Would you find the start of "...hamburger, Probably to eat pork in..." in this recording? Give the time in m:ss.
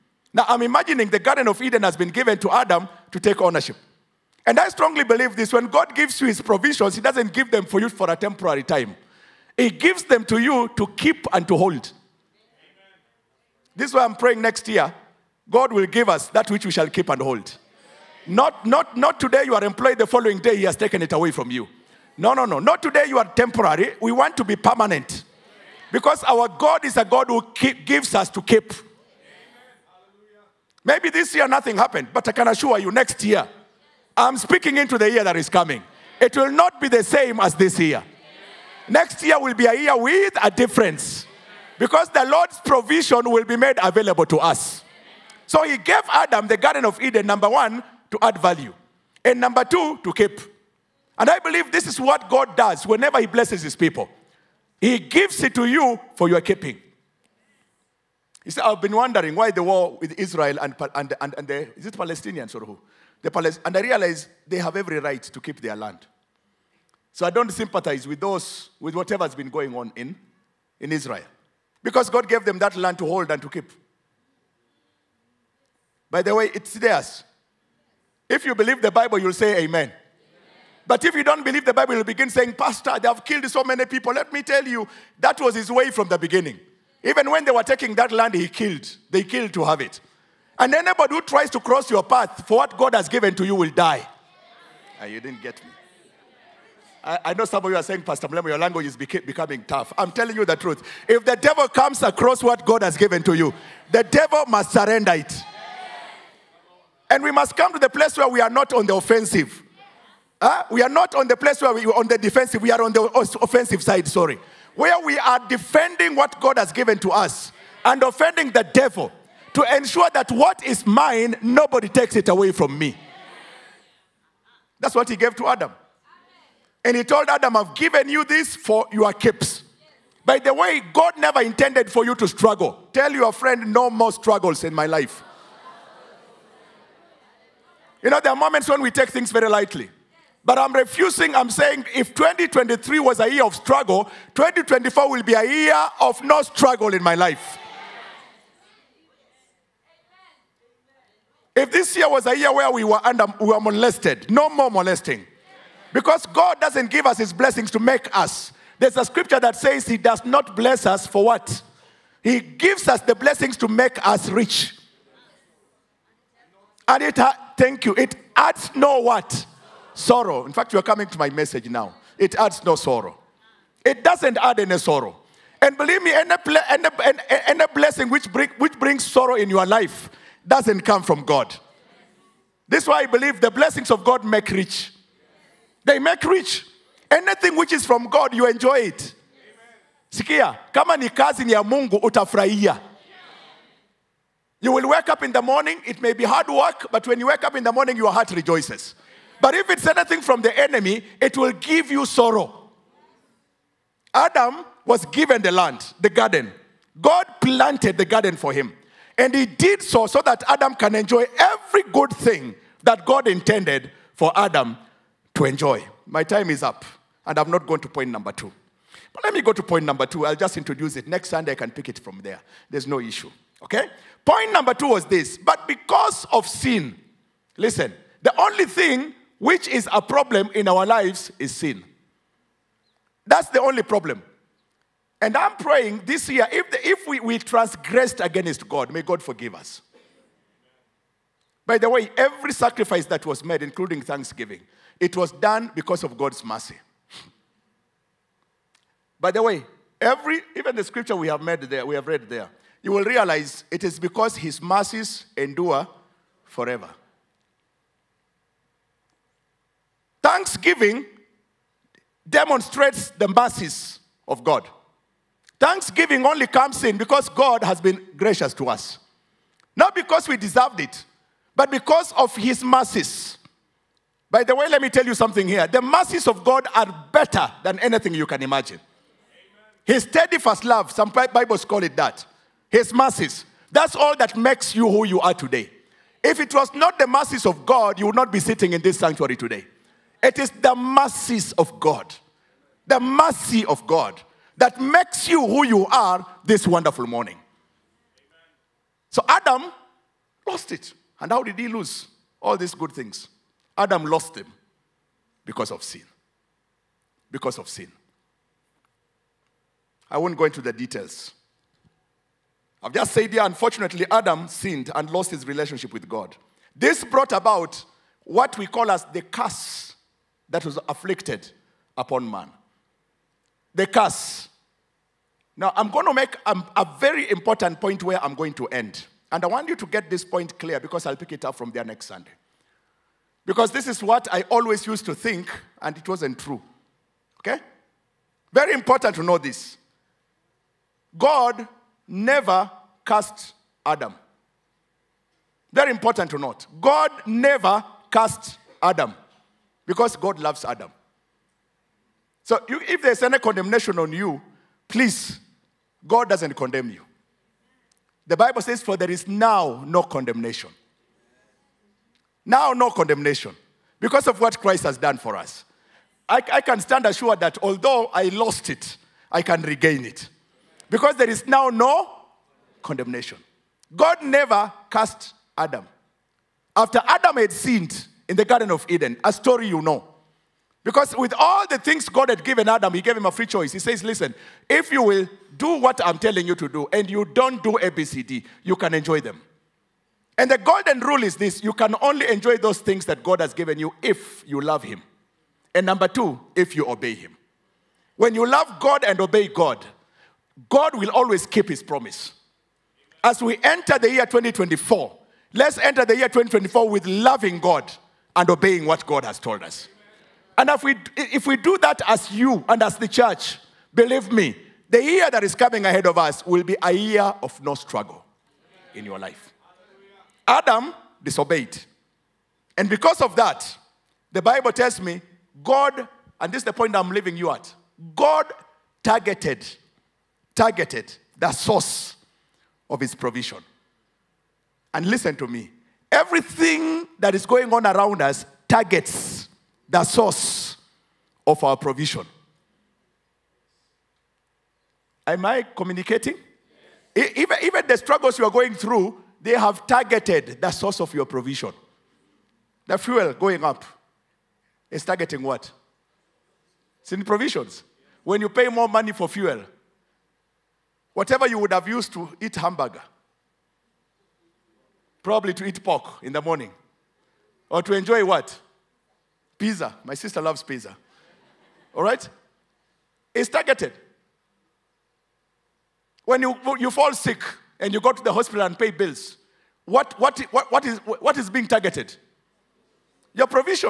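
7:42.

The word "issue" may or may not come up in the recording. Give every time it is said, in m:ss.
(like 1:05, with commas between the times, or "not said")
3:42.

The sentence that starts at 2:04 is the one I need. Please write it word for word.
That's what he gave to Adam.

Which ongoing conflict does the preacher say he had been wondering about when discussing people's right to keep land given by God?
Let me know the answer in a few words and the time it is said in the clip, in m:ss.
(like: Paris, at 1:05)
The war with Israel, at 0:59.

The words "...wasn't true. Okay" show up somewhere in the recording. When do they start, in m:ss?
5:36.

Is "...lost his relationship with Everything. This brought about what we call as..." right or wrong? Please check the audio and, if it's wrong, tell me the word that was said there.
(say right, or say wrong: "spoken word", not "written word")
wrong: "God", not "Everything".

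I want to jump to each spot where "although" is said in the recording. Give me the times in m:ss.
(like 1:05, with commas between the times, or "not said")
6:07.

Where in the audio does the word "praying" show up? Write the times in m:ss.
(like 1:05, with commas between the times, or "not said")
0:14, 3:55.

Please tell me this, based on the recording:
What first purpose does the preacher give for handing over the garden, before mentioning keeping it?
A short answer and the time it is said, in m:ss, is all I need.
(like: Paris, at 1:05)
To add value, at 0:48.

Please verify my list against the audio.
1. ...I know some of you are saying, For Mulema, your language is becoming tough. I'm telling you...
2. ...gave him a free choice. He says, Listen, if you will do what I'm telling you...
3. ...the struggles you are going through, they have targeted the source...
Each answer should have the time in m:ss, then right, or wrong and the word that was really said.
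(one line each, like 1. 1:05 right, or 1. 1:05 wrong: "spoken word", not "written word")
1. 1:37 wrong: "Pastor", not "For"
2. 6:23 right
3. 7:27 right.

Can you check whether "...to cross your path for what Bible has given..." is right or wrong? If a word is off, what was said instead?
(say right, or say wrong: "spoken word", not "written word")
wrong: "God", not "Bible".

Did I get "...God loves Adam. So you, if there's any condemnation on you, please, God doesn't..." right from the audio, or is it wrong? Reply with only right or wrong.
right.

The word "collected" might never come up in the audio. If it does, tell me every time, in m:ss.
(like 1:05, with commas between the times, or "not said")
not said.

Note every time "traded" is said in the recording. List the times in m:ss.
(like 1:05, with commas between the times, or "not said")
not said.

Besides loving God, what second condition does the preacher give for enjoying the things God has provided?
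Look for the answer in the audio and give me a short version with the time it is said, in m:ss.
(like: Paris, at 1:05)
Obey Him, at 6:36.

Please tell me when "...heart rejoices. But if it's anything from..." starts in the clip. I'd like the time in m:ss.
3:18.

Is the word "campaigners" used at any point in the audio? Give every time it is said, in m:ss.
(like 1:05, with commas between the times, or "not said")
not said.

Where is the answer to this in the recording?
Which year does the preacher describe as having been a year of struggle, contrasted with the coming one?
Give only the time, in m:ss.
2:22.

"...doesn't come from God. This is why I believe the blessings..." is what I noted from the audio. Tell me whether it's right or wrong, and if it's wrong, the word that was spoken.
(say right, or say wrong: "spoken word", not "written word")
right.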